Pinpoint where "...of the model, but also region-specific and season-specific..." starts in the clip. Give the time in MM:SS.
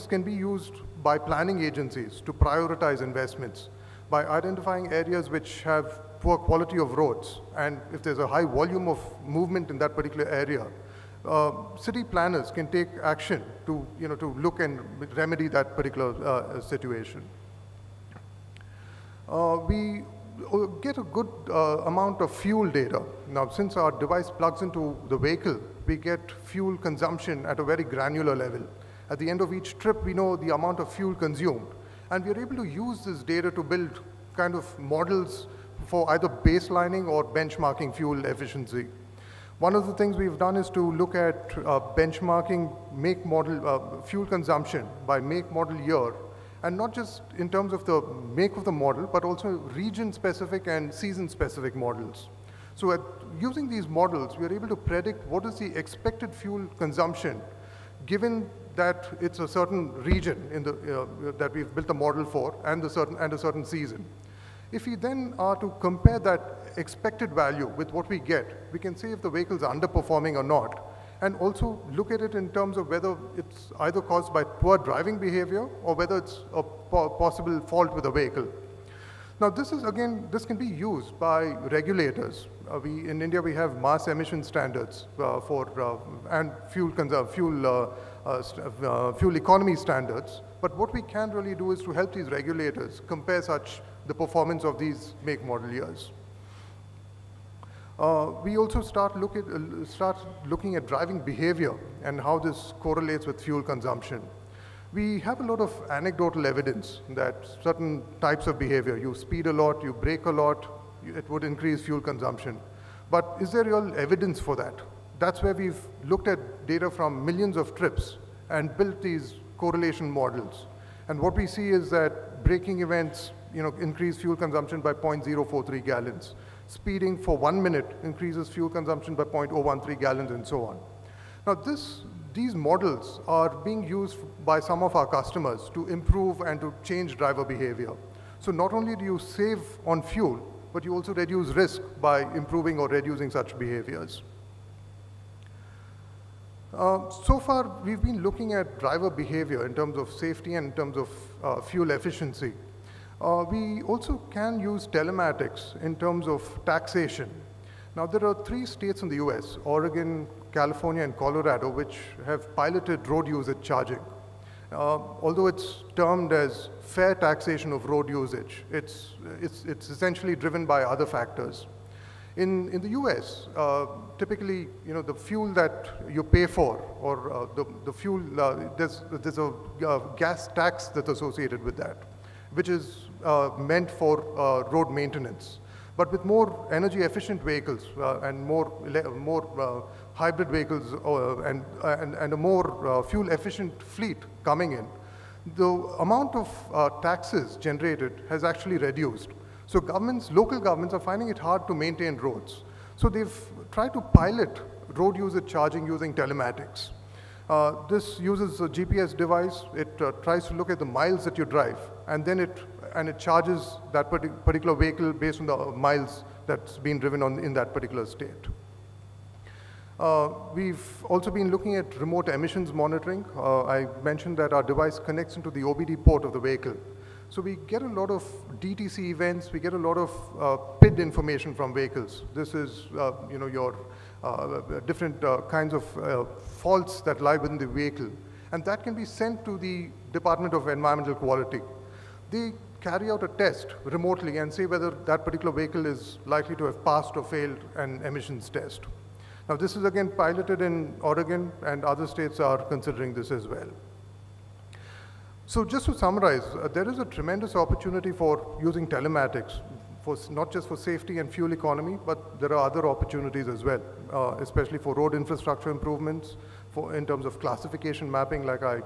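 00:48.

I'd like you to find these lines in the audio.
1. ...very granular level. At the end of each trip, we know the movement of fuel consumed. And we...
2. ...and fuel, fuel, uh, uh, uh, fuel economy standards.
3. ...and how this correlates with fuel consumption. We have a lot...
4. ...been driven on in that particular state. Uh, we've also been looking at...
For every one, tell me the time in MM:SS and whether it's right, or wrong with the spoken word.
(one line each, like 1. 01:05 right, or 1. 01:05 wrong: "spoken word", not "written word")
1. 00:27 wrong: "amount", not "movement"
2. 01:26 right
3. 01:42 right
4. 03:36 right.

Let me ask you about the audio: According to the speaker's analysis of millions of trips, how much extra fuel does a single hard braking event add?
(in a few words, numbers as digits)
0.043 gallons.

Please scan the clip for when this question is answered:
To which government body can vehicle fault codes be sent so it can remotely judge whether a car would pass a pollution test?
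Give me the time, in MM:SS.
04:00.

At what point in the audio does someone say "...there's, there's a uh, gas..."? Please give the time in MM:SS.
02:58.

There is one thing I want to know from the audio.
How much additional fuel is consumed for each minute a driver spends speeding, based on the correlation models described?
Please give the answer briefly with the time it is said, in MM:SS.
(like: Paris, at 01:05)
0.013 gallons, at 02:09.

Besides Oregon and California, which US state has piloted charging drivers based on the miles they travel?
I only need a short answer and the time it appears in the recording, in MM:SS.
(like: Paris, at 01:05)
Colorado, at 02:41.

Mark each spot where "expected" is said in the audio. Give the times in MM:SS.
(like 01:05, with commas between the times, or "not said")
00:55, 01:06.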